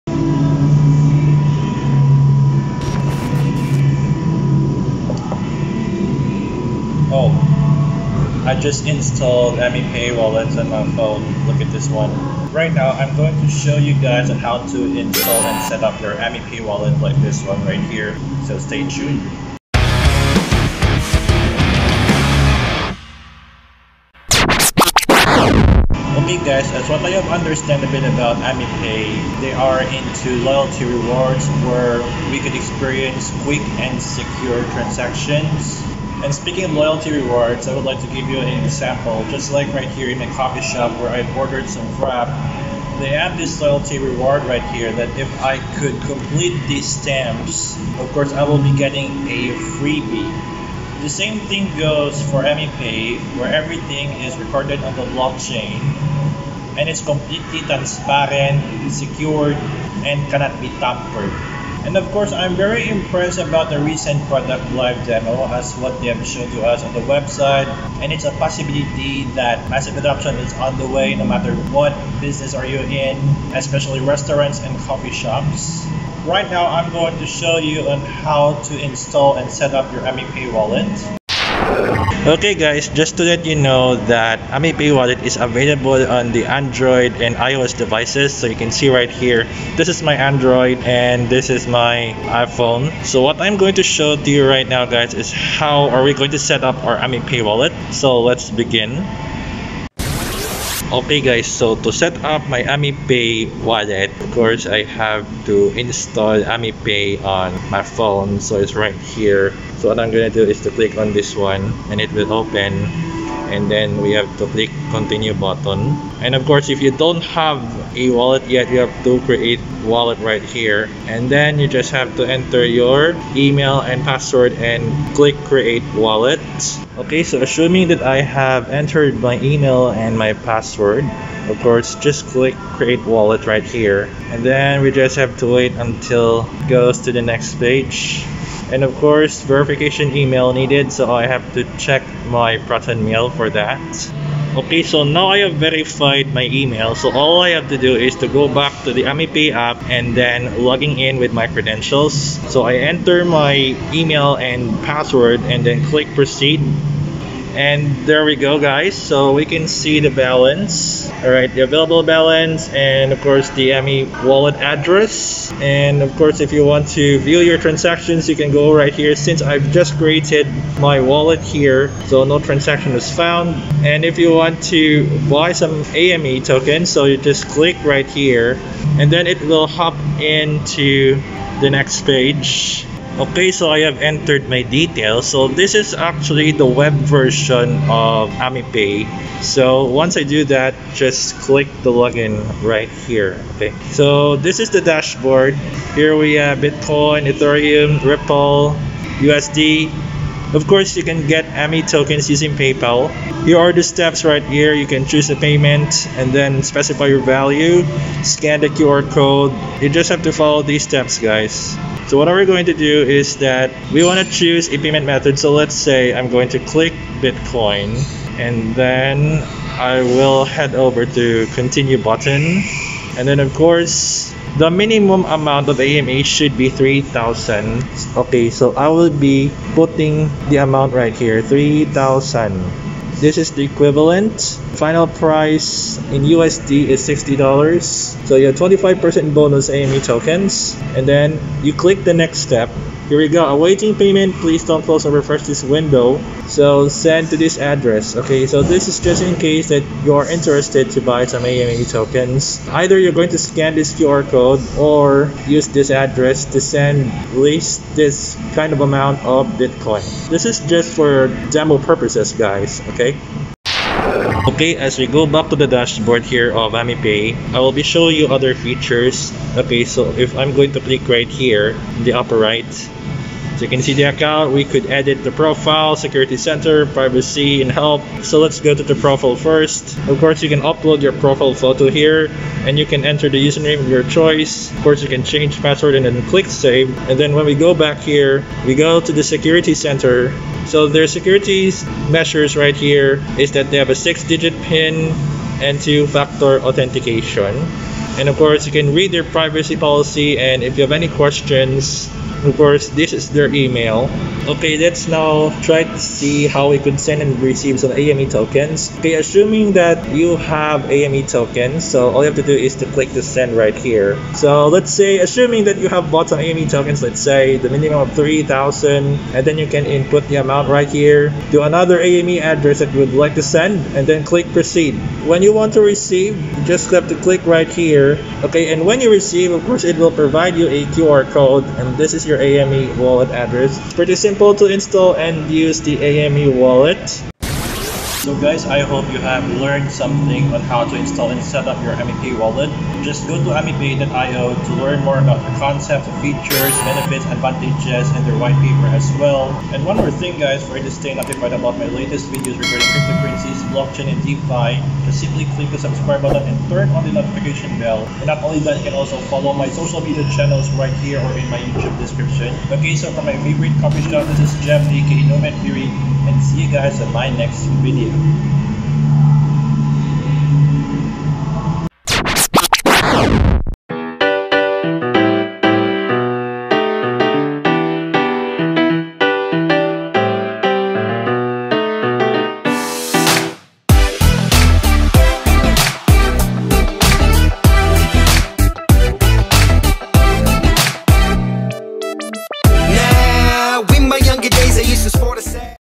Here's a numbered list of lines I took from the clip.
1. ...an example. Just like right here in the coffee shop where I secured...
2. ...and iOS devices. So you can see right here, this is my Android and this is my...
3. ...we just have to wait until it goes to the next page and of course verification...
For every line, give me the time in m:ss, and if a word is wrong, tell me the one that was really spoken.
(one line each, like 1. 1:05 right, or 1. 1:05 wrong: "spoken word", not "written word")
1. 0:38 wrong: "ordered", not "secured"
2. 1:27 right
3. 2:14 right.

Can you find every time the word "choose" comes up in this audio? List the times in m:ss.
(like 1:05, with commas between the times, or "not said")
3:25, 3:34.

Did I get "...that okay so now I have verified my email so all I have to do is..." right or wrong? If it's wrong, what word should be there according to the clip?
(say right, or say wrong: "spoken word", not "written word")
right.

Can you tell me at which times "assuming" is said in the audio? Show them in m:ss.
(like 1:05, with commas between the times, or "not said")
2:07, 5:09, 5:15.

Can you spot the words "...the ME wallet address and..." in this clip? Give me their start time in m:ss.
2:43.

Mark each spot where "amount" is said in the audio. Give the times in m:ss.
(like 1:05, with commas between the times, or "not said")
3:45, 3:50, 4:18, 5:20.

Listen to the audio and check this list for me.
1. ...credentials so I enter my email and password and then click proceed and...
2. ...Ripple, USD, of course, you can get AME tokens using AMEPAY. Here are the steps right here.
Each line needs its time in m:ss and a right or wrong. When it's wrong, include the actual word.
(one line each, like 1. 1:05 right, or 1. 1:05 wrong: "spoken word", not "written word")
1. 2:31 right
2. 3:17 wrong: "PayPal", not "AMEPAY".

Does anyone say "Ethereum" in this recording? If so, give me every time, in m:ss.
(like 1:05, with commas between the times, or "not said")
3:17.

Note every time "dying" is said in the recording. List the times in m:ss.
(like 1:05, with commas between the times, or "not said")
not said.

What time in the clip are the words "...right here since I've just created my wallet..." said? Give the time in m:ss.
2:48.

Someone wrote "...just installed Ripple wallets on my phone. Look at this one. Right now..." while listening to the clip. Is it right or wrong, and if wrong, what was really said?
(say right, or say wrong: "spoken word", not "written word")
wrong: "AMEPAY", not "Ripple".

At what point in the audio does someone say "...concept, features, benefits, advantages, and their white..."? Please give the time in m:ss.
5:45.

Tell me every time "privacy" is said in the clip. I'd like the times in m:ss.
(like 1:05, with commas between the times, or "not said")
4:36, 4:59.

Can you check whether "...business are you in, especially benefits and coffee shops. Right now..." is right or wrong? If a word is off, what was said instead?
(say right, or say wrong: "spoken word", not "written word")
wrong: "restaurants", not "benefits".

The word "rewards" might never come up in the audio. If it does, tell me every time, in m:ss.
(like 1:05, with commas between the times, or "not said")
0:30, 0:37, 0:43.